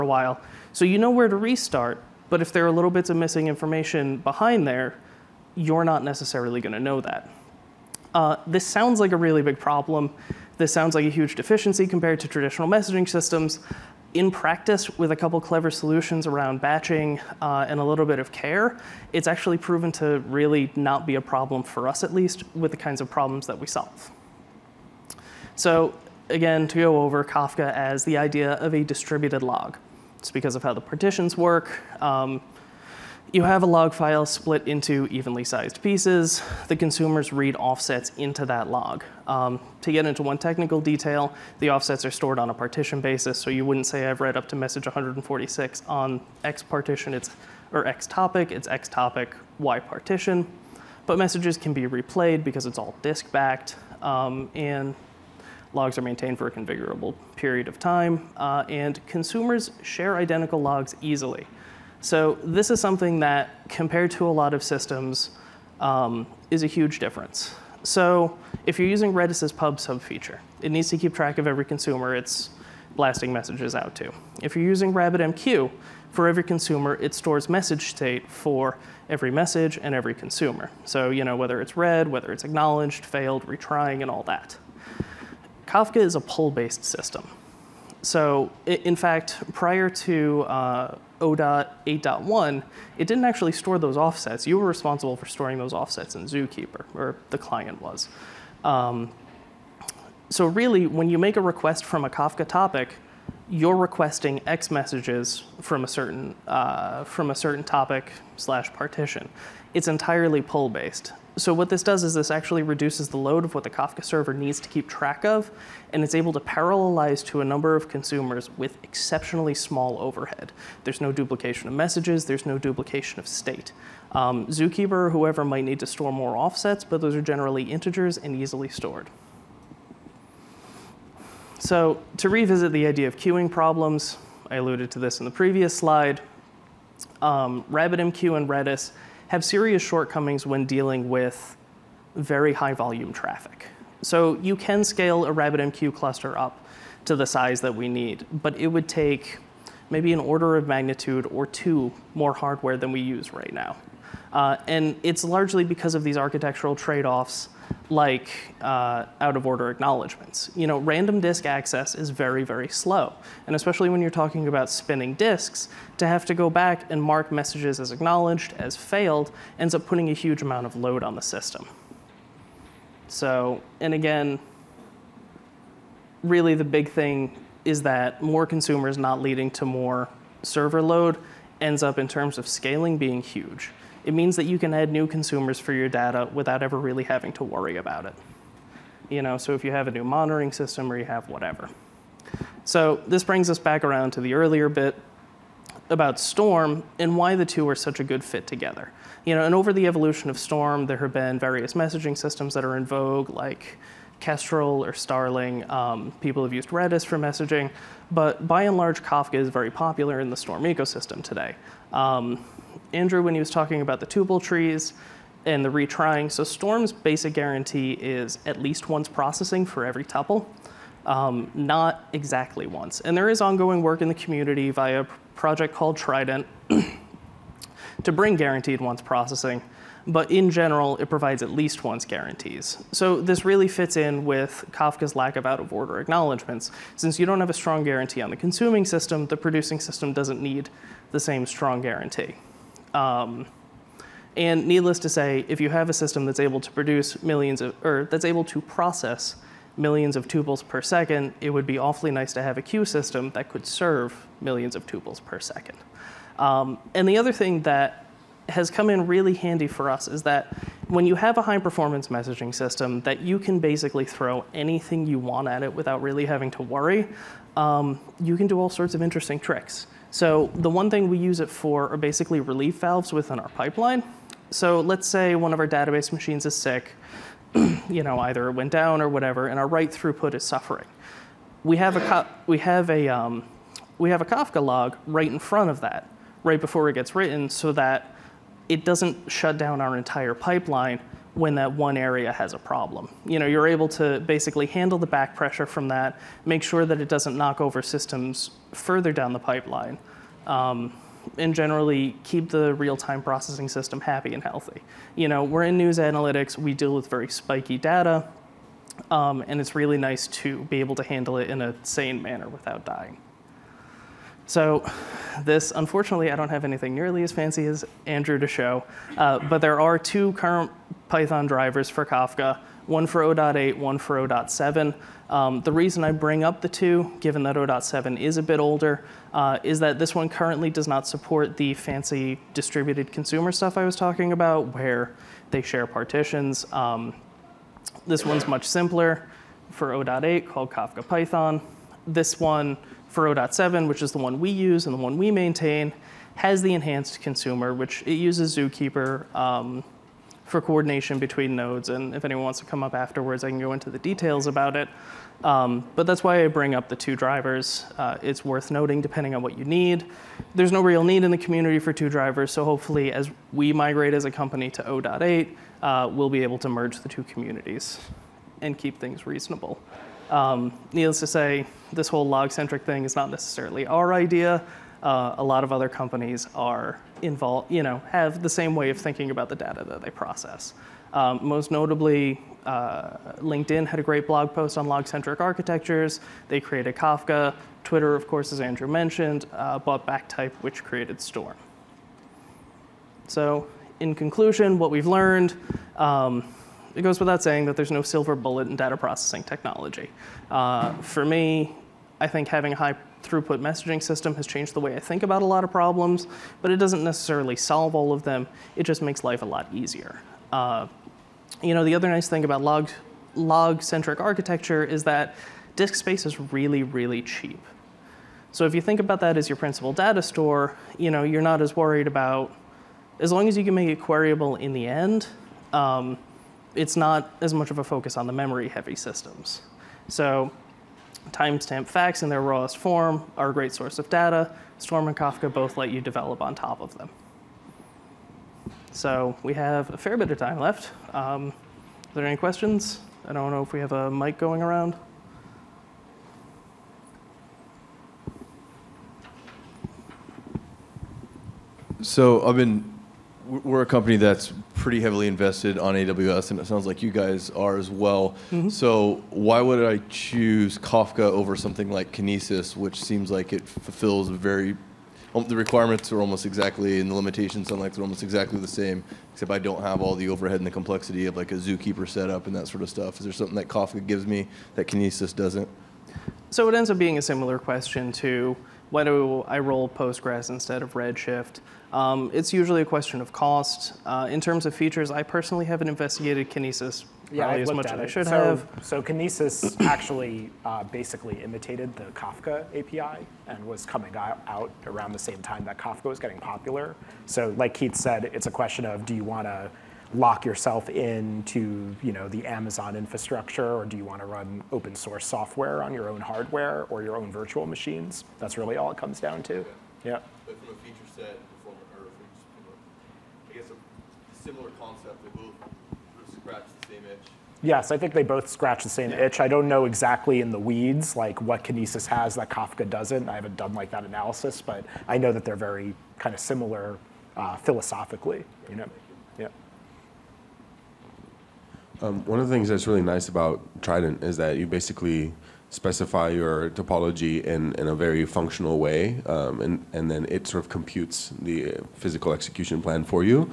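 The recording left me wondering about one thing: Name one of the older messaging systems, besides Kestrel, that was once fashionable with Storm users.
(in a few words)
Starling.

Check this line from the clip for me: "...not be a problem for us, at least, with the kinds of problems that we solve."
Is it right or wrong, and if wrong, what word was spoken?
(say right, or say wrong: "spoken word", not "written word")
right.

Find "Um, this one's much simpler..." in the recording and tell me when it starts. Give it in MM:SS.
05:36.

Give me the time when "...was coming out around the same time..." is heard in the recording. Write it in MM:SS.
08:13.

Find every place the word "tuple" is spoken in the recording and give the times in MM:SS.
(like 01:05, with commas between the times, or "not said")
03:34, 03:40, 04:10, 04:14.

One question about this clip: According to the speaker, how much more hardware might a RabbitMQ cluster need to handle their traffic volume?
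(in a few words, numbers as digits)
an order of magnitude or two.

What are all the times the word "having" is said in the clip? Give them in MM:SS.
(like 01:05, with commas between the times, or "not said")
03:07, 04:26, 06:42.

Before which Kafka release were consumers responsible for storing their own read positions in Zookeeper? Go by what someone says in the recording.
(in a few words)
0.8.1.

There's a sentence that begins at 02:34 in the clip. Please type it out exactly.
Uh, and it's largely because of these architectural trade-offs like uh, out of order acknowledgments.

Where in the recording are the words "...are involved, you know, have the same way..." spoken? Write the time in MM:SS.
06:16.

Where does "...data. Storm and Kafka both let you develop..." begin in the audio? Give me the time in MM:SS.
07:14.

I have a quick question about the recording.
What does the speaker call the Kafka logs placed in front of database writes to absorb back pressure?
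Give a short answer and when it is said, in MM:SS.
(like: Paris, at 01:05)
relief valves, at 04:32.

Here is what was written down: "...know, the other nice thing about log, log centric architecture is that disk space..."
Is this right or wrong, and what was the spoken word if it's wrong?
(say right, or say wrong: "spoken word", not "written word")
right.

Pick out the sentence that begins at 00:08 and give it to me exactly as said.
Uh, this sounds like a really big problem.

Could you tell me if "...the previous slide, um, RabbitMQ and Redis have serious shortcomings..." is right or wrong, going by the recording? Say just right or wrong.
right.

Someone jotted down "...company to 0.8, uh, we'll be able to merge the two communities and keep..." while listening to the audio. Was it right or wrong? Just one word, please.
right.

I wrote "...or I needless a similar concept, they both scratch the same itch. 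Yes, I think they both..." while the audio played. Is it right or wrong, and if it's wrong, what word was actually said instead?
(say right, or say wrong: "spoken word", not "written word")
wrong: "guess", not "needless".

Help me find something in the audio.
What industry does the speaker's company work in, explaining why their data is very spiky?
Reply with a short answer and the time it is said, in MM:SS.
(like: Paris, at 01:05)
news analytics, at 05:05.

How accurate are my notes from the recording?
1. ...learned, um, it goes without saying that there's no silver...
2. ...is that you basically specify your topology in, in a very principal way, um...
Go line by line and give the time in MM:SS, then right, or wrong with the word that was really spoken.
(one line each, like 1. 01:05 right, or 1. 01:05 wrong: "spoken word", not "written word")
1. 06:35 right
2. 08:54 wrong: "functional", not "principal".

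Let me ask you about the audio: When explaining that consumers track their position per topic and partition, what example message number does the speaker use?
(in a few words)
146.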